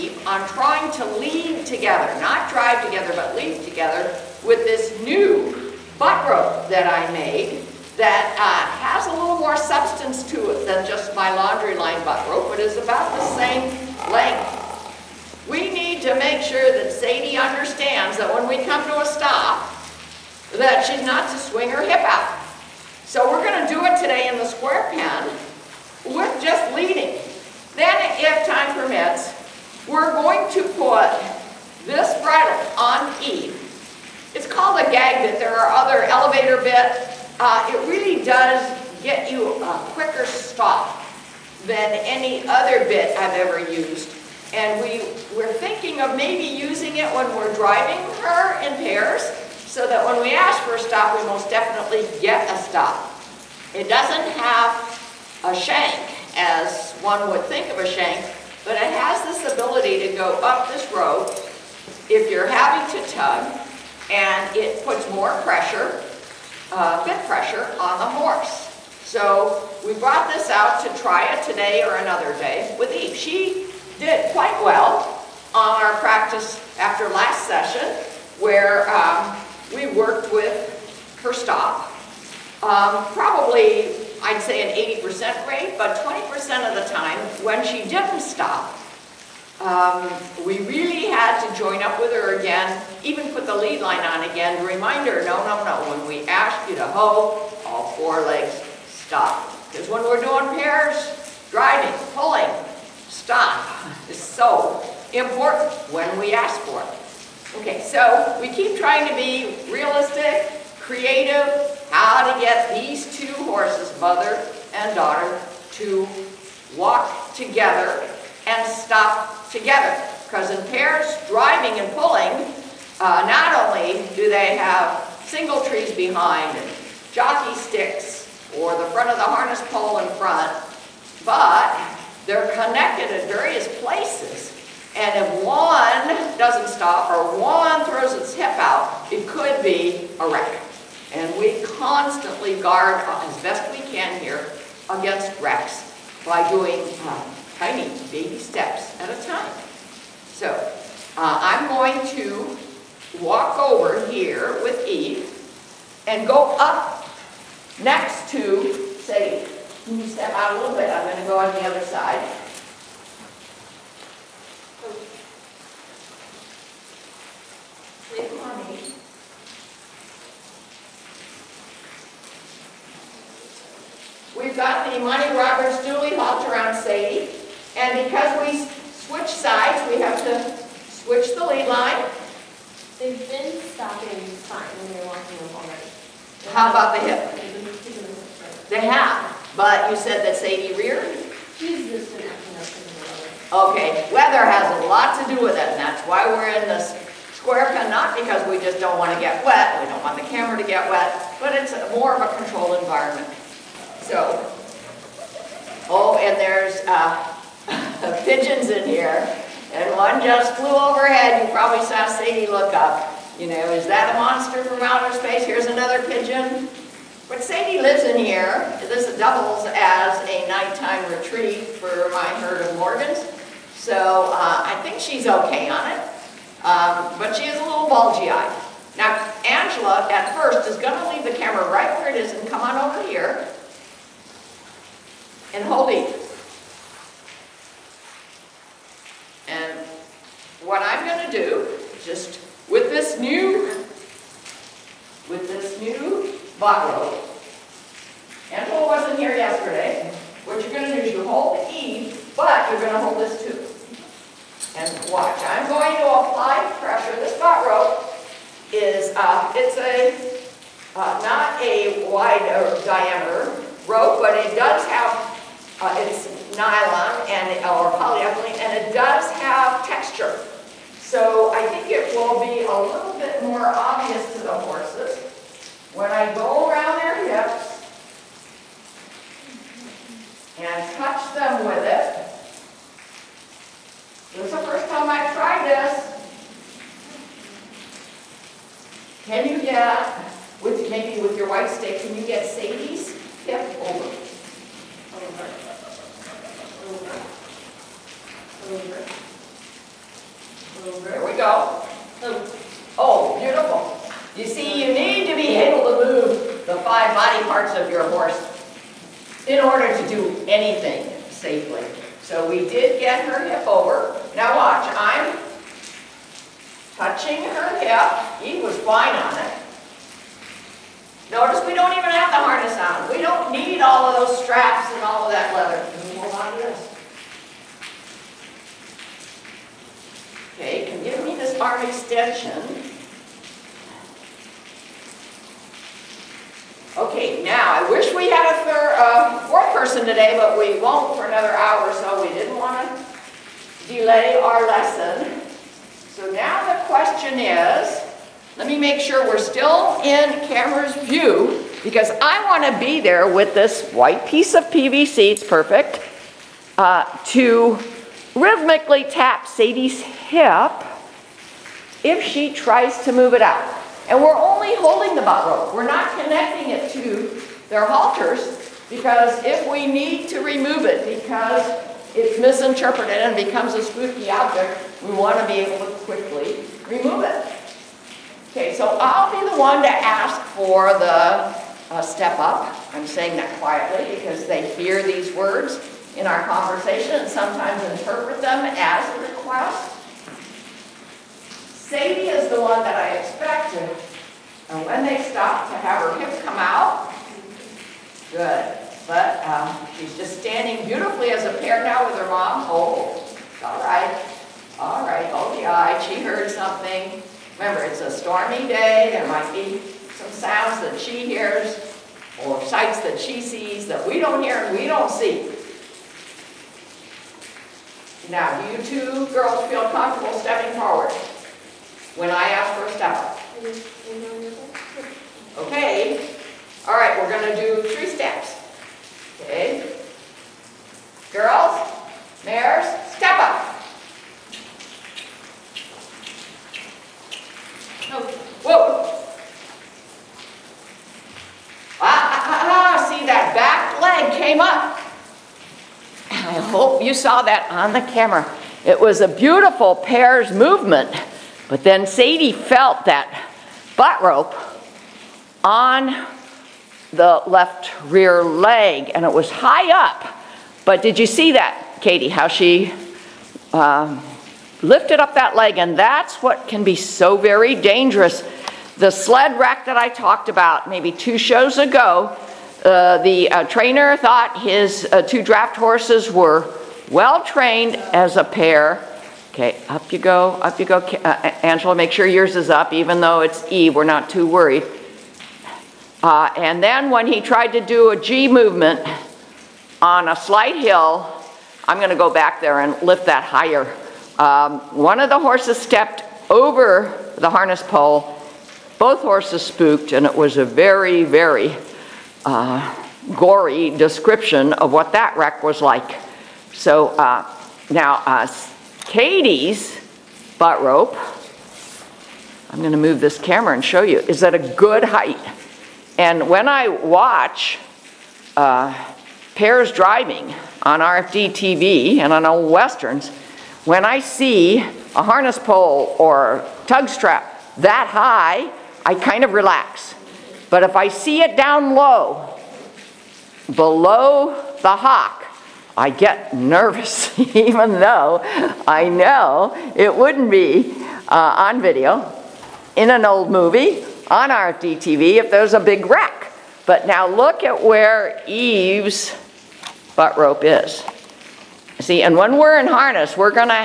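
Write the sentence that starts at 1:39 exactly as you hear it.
Because when we're doing pairs, driving, pulling, stop is so important when we ask for it.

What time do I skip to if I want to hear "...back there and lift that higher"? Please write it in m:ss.
8:12.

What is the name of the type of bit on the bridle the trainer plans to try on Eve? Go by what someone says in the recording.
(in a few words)
Gag bit.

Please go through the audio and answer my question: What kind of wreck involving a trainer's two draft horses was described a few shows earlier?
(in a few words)
Sled wreck.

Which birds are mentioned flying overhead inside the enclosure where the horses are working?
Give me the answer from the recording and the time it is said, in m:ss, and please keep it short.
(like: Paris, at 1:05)
Pigeons, at 3:28.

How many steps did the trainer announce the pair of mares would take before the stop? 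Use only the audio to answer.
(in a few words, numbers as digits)
3.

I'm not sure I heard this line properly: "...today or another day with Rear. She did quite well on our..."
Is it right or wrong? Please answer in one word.
wrong.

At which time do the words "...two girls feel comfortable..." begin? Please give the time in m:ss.
6:58.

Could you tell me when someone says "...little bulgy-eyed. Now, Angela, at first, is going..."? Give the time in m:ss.
3:47.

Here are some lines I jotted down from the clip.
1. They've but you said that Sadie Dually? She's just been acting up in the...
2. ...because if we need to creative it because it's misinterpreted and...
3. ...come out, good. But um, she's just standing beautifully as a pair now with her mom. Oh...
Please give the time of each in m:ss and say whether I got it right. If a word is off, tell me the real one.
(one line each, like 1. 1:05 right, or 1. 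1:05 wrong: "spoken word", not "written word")
1. 3:08 wrong: "Rear", not "Dually"
2. 6:08 wrong: "remove", not "creative"
3. 6:36 right.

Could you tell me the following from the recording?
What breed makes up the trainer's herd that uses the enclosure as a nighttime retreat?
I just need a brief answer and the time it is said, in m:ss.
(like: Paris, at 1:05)
Morgans, at 3:42.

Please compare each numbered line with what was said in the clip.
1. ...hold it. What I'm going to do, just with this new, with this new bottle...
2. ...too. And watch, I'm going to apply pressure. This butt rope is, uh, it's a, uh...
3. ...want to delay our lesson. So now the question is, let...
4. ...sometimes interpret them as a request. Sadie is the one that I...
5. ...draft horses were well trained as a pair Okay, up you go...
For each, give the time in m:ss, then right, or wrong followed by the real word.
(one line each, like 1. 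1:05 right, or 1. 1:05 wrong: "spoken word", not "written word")
1. 3:55 right
2. 4:13 right
3. 5:42 right
4. 6:27 right
5. 7:55 right.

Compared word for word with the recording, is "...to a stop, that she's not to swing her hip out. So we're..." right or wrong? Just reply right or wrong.
right.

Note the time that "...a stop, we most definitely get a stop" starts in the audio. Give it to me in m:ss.
0:50.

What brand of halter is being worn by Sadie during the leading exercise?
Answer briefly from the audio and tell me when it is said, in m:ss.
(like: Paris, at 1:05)
Monty Roberts Dually, at 2:54.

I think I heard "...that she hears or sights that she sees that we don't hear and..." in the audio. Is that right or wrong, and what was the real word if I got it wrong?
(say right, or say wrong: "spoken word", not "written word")
right.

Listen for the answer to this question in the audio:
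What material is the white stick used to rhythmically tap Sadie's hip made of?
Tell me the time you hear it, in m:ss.
5:54.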